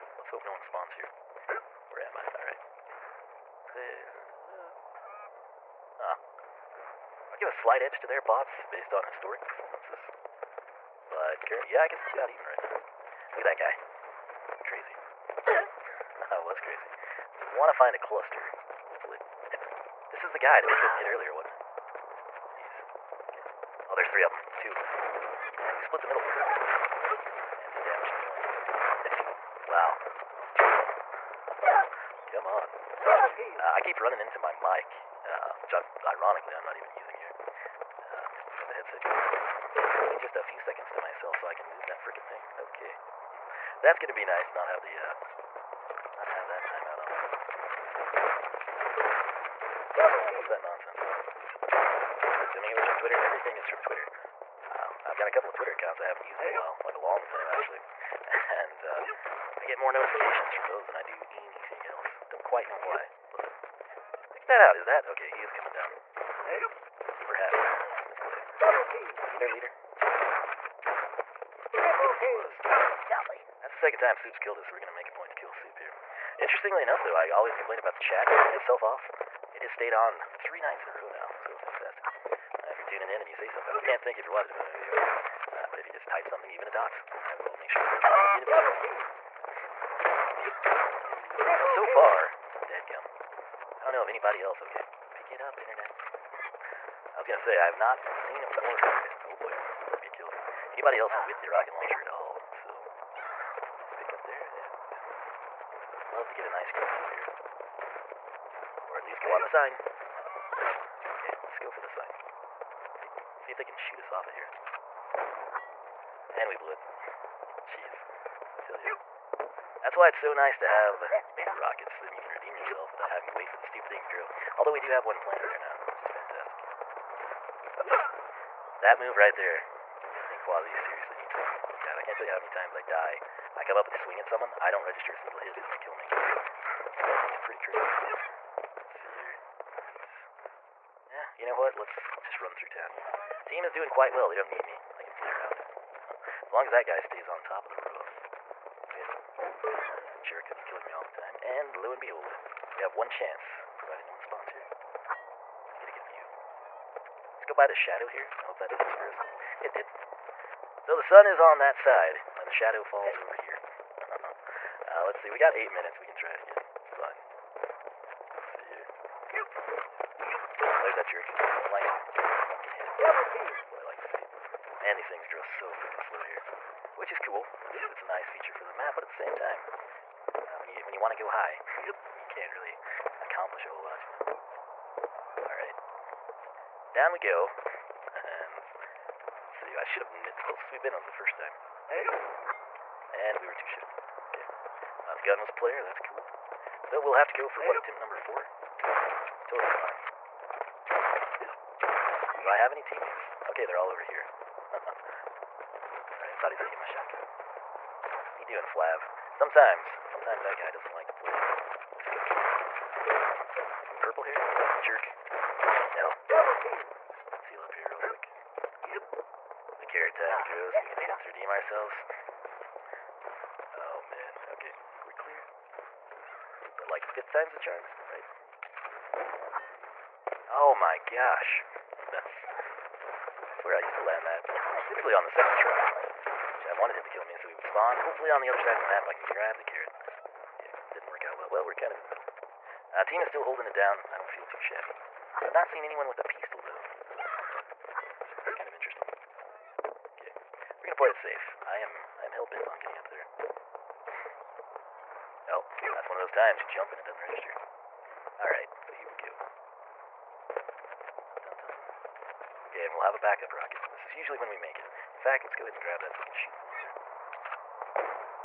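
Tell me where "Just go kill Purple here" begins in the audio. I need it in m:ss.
3:31.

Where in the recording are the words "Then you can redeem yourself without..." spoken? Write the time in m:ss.
2:01.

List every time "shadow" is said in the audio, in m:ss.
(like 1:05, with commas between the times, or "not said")
2:37, 2:42.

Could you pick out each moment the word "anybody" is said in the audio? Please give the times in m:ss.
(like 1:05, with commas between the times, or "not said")
1:34, 1:40.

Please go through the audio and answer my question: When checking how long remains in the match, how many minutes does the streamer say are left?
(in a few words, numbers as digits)
8.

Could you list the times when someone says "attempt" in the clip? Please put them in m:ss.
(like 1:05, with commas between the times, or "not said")
3:17, 3:40.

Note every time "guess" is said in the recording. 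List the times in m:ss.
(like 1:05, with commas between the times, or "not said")
0:11.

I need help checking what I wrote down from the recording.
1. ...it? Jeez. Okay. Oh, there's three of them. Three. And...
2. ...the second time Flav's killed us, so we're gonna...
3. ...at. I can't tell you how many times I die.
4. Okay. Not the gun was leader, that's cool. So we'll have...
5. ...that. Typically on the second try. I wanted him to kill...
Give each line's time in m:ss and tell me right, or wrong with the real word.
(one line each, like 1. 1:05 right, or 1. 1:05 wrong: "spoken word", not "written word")
1. 0:21 wrong: "Two", not "Three"
2. 1:13 wrong: "Soup", not "Flav"
3. 2:11 right
4. 3:14 wrong: "player", not "leader"
5. 3:54 right.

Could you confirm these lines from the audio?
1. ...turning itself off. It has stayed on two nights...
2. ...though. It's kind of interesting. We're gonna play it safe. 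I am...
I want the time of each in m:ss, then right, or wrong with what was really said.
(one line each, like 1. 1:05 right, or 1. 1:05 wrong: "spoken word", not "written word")
1. 1:18 wrong: "three", not "two"
2. 4:06 right.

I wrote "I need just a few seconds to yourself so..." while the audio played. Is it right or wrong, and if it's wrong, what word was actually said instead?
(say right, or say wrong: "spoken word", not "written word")
wrong: "myself", not "yourself".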